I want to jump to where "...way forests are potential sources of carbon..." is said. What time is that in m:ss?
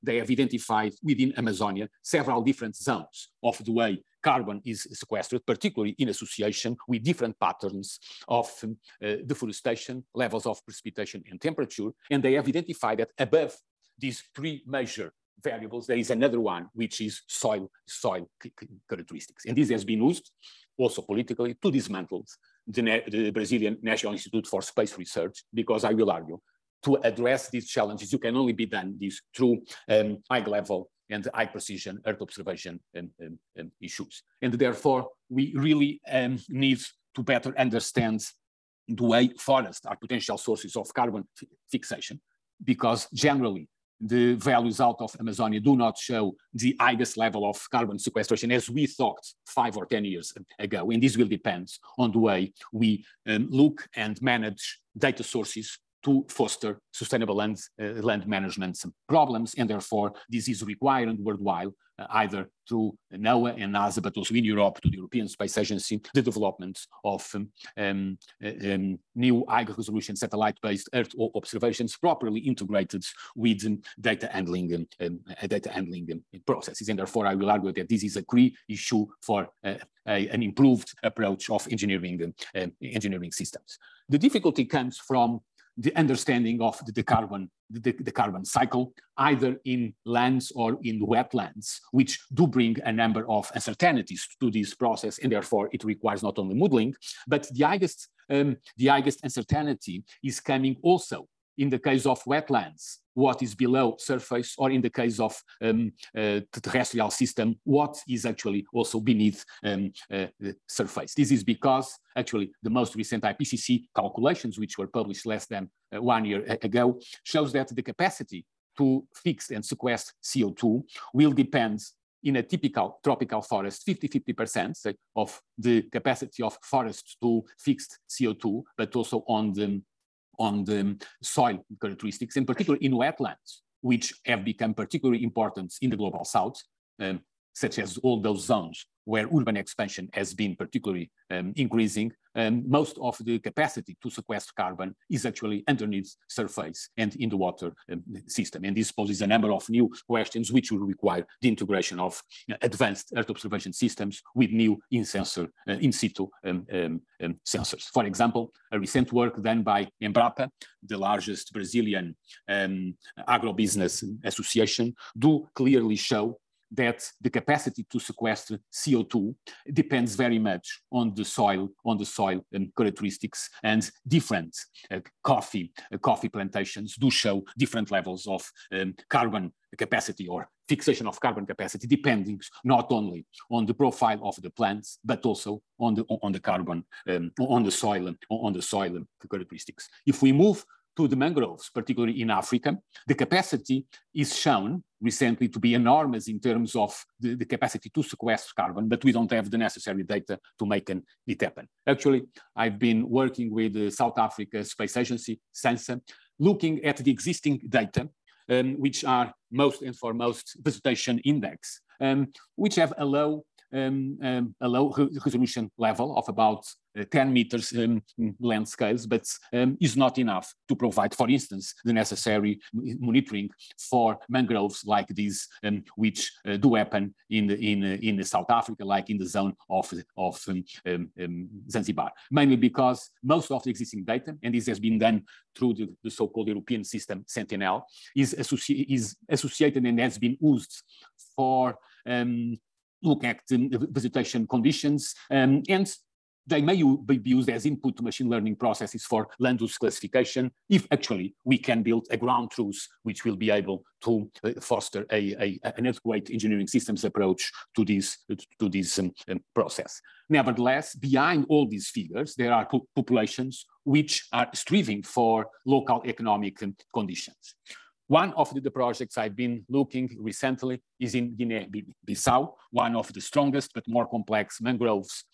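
0:39.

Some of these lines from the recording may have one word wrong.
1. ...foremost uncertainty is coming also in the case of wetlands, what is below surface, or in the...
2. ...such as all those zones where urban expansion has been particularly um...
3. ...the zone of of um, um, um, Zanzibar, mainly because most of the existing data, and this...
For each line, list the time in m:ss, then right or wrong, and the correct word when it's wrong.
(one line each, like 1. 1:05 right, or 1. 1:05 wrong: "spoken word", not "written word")
1. 1:38 wrong: "highest", not "foremost"
2. 2:17 right
3. 3:49 right.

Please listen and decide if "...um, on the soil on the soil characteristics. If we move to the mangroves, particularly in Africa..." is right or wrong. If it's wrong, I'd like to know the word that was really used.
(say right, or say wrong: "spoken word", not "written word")
right.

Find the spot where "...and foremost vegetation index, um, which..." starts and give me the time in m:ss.
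3:29.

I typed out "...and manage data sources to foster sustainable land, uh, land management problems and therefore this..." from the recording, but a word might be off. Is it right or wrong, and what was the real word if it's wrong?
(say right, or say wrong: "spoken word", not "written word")
right.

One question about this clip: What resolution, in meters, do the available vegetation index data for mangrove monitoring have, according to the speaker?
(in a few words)
10 meters.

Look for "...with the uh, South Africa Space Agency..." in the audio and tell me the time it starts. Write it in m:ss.
3:23.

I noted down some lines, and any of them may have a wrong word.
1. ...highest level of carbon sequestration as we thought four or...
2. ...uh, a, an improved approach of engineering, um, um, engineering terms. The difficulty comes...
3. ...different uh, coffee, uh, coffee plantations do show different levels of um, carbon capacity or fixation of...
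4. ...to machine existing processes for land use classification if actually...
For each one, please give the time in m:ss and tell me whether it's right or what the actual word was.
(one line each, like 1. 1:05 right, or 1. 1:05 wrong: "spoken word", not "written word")
1. 0:46 wrong: "five", not "four"
2. 1:19 wrong: "systems", not "terms"
3. 2:54 right
4. 4:07 wrong: "learning", not "existing".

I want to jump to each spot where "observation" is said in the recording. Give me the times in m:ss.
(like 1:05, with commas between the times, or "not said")
0:32, 1:11, 2:33.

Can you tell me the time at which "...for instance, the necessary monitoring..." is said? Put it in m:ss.
3:41.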